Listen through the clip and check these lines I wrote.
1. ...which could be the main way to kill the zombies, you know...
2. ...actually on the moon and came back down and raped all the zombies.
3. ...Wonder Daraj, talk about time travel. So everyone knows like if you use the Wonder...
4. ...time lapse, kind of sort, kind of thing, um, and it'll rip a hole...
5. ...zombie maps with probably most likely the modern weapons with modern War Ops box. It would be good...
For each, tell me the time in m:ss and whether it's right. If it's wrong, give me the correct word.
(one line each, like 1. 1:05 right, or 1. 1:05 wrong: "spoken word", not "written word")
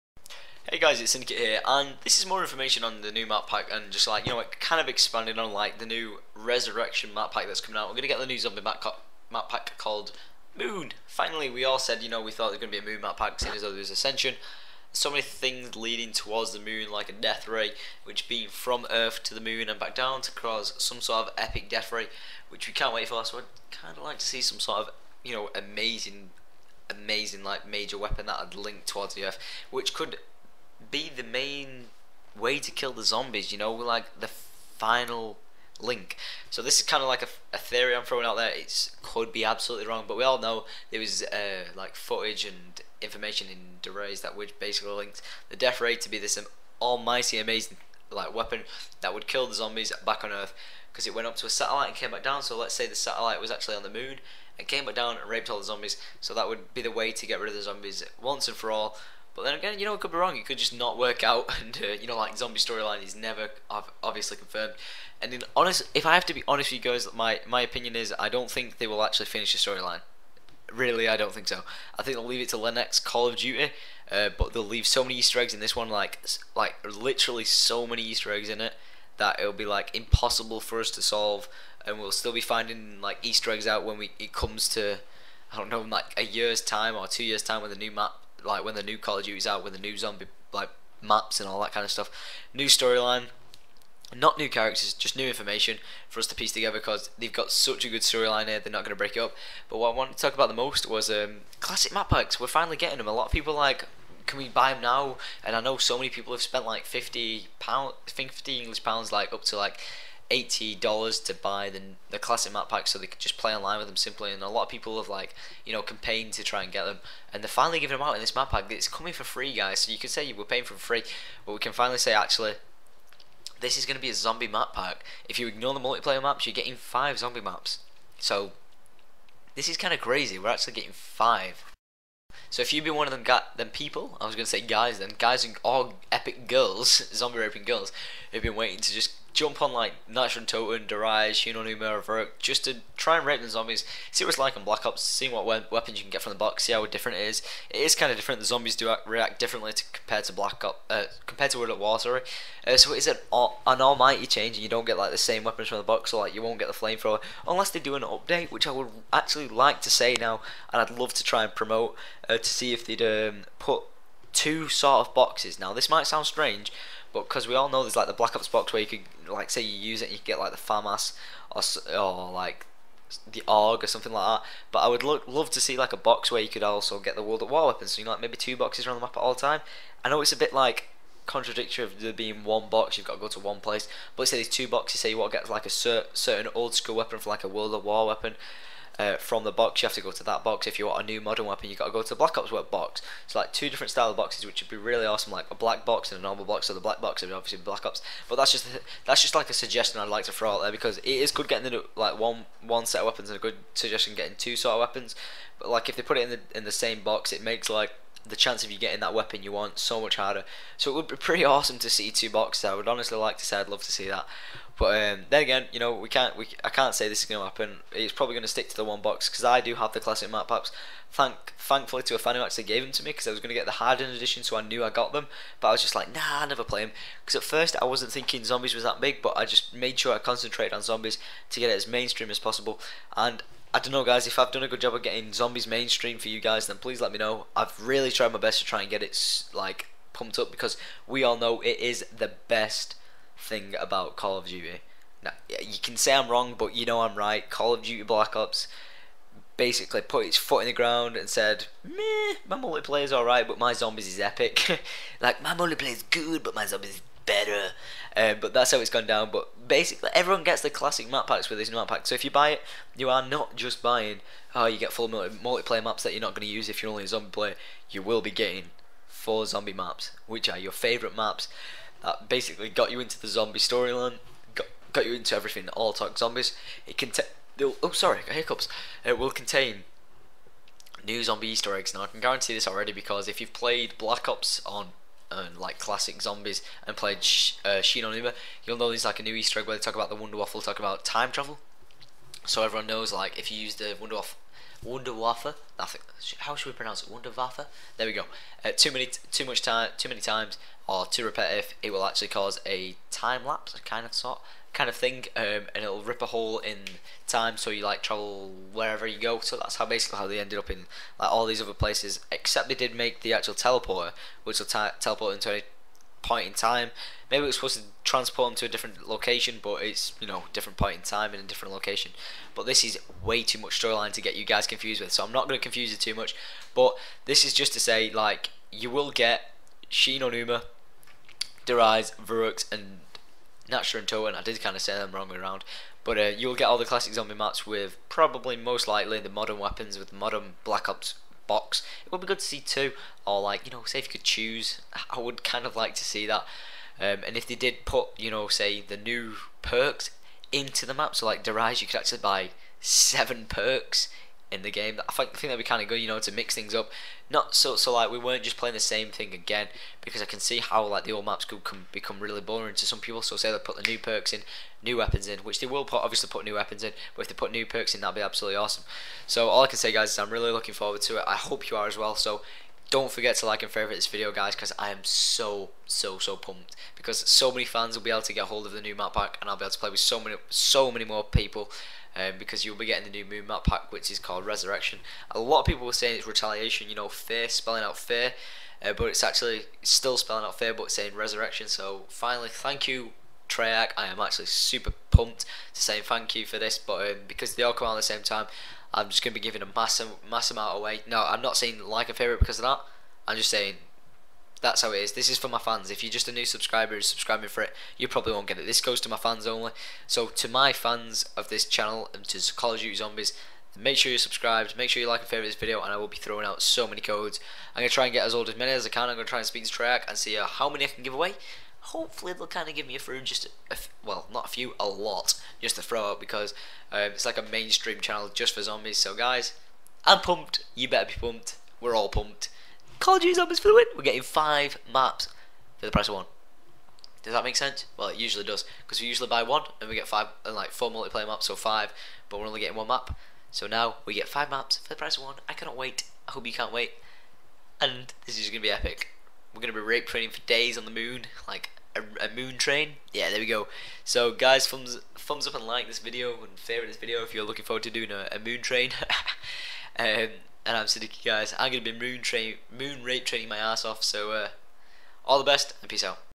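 1. 0:29 right
2. 0:53 right
3. 4:50 wrong: "Waffle", not "Daraj"
4. 5:03 right
5. 5:37 wrong: "Black", not "War".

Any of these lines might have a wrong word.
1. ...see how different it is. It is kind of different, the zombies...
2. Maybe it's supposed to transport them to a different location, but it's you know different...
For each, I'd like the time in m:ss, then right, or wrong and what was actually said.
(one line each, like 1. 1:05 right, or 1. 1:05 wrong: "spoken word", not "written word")
1. 2:26 right
2. 5:17 right.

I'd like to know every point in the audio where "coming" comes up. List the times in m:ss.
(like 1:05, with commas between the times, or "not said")
0:07, 1:58.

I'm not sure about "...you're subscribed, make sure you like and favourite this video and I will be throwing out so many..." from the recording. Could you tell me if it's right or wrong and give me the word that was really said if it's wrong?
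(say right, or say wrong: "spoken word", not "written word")
right.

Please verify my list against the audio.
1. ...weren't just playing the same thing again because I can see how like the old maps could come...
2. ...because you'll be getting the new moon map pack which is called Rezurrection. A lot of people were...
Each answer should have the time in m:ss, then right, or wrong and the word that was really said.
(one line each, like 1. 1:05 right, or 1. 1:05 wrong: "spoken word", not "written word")
1. 5:58 right
2. 6:22 right.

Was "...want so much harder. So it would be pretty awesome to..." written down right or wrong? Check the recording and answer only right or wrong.
right.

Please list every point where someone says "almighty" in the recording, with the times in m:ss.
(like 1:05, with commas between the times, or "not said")
0:46, 2:33.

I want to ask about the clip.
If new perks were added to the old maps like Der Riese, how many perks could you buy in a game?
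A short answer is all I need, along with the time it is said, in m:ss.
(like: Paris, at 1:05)
7, at 5:52.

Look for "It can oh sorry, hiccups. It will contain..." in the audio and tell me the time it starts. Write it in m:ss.
4:36.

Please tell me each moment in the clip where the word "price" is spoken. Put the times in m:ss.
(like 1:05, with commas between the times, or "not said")
7:15, 7:24.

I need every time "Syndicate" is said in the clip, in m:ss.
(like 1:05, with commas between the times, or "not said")
0:01, 7:40.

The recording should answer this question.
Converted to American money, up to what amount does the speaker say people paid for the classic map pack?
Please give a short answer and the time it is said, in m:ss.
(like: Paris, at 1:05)
$80, at 1:50.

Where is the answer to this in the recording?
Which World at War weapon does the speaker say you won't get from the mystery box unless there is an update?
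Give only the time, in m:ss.
2:36.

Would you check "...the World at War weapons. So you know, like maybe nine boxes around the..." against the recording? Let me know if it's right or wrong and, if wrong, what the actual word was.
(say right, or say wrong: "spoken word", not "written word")
wrong: "two", not "nine".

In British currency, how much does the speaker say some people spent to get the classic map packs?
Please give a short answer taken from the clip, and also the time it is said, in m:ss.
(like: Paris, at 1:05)
50 pounds, at 1:46.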